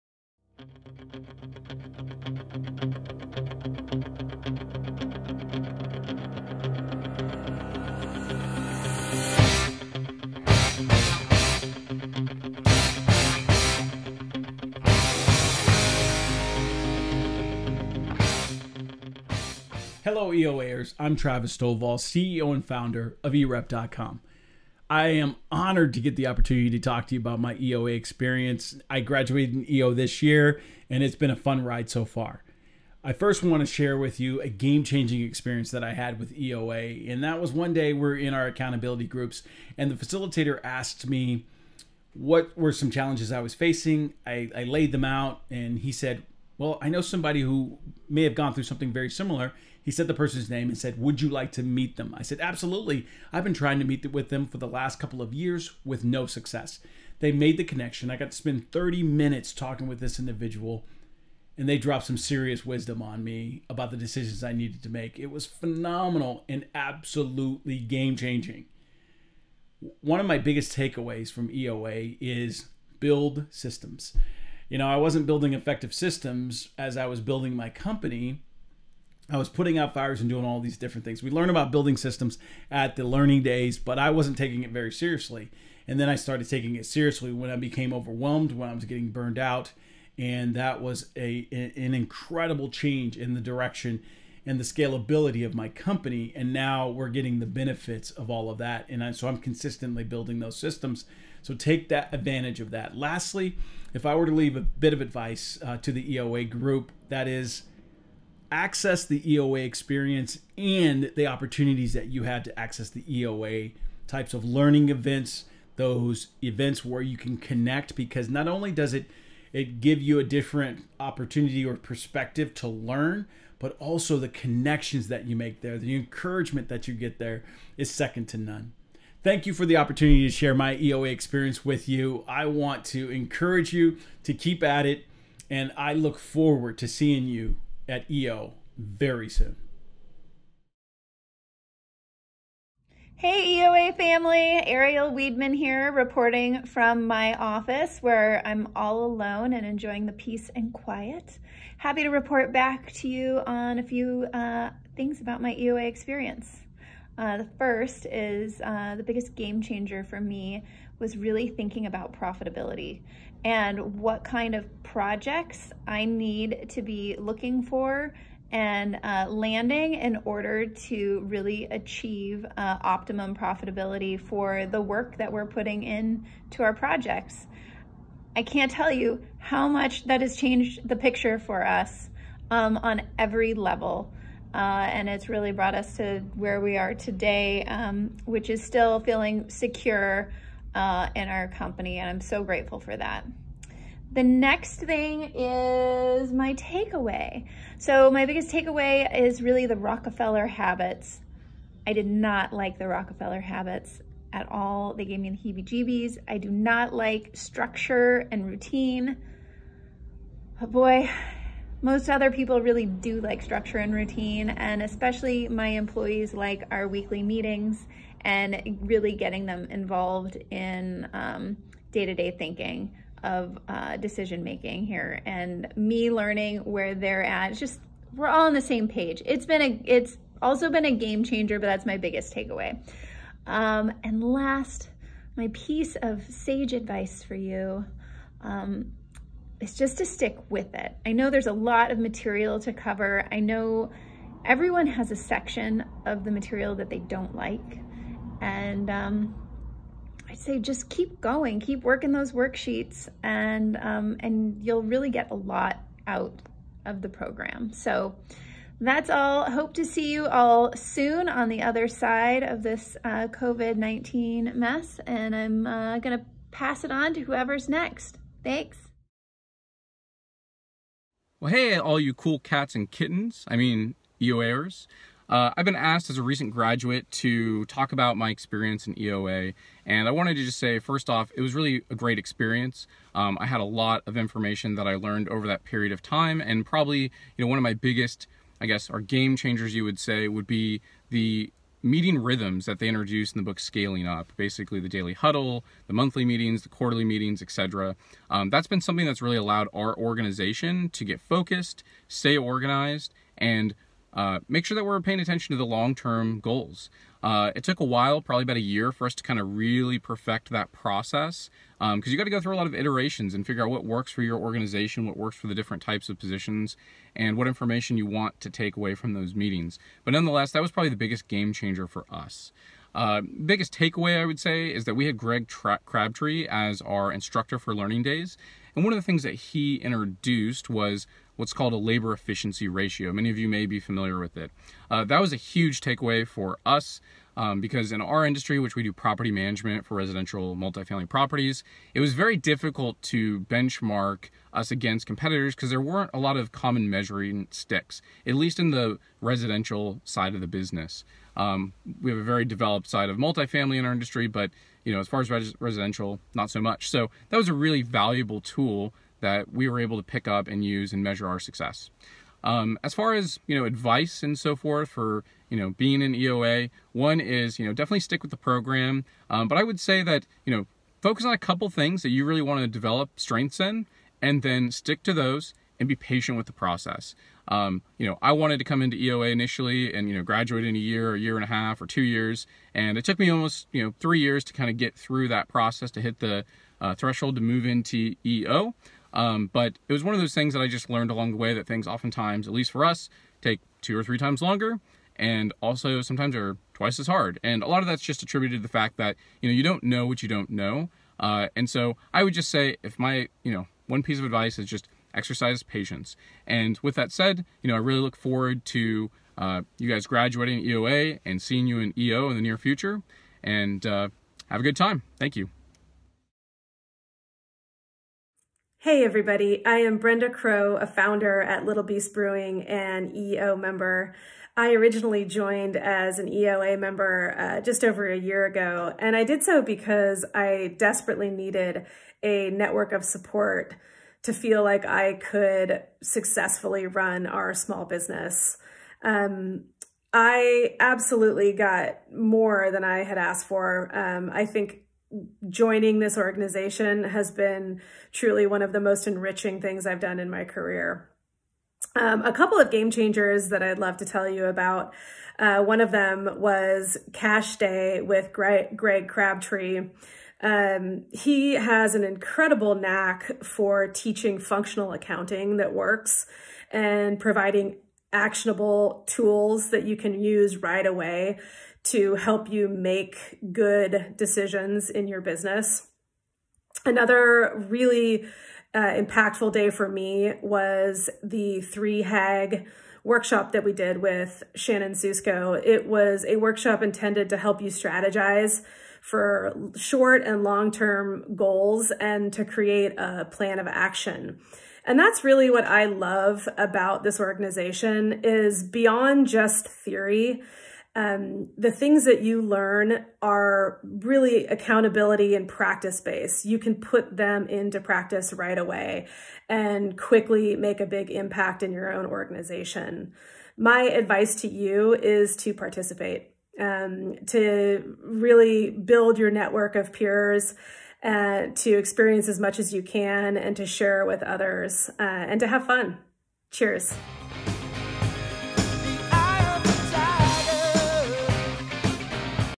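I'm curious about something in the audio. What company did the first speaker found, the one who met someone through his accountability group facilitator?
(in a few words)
EREP.com.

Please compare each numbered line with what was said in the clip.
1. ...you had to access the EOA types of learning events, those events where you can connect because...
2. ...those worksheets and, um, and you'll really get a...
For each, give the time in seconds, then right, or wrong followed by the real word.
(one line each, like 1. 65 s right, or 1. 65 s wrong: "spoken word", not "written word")
1. 112 s right
2. 252 s right.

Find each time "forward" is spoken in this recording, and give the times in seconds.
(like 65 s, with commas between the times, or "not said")
136 s, 408 s.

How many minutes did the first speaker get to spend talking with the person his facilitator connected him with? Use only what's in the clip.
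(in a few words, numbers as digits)
30.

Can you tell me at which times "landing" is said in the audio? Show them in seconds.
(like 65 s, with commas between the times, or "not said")
169 s.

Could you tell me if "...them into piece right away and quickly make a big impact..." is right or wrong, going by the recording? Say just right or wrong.
wrong.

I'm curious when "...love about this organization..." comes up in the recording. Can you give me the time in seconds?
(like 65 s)
495 s.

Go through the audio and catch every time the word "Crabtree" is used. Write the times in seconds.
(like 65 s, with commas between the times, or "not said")
325 s, 459 s.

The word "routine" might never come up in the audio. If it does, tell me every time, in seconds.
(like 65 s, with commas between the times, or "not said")
208 s, 213 s.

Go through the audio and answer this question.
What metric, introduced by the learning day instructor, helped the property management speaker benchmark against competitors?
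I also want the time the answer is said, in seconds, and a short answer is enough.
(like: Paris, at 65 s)
labor efficiency ratio, at 331 s.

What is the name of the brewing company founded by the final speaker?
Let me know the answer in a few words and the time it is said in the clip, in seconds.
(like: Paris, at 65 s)
Little Beast Brewing, at 421 s.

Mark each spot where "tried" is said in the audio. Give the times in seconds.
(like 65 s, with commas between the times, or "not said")
not said.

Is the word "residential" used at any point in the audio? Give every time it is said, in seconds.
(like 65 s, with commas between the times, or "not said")
339 s, 349 s, 355 s.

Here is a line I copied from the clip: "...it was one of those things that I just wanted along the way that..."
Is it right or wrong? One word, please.
wrong.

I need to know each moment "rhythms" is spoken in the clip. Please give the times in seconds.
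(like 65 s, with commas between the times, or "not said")
292 s.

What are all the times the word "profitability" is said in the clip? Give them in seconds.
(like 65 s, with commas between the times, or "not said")
162 s, 173 s.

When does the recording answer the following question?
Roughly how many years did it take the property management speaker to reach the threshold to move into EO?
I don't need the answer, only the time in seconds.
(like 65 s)
383 s.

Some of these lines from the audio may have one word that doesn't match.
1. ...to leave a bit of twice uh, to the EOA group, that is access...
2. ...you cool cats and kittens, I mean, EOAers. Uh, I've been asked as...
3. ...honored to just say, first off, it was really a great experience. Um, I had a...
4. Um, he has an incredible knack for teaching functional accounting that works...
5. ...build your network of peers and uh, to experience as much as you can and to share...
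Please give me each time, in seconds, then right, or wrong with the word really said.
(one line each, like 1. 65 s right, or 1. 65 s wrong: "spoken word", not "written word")
1. 104 s wrong: "advice", not "twice"
2. 271 s right
3. 280 s wrong: "wanted", not "honored"
4. 460 s right
5. 518 s right.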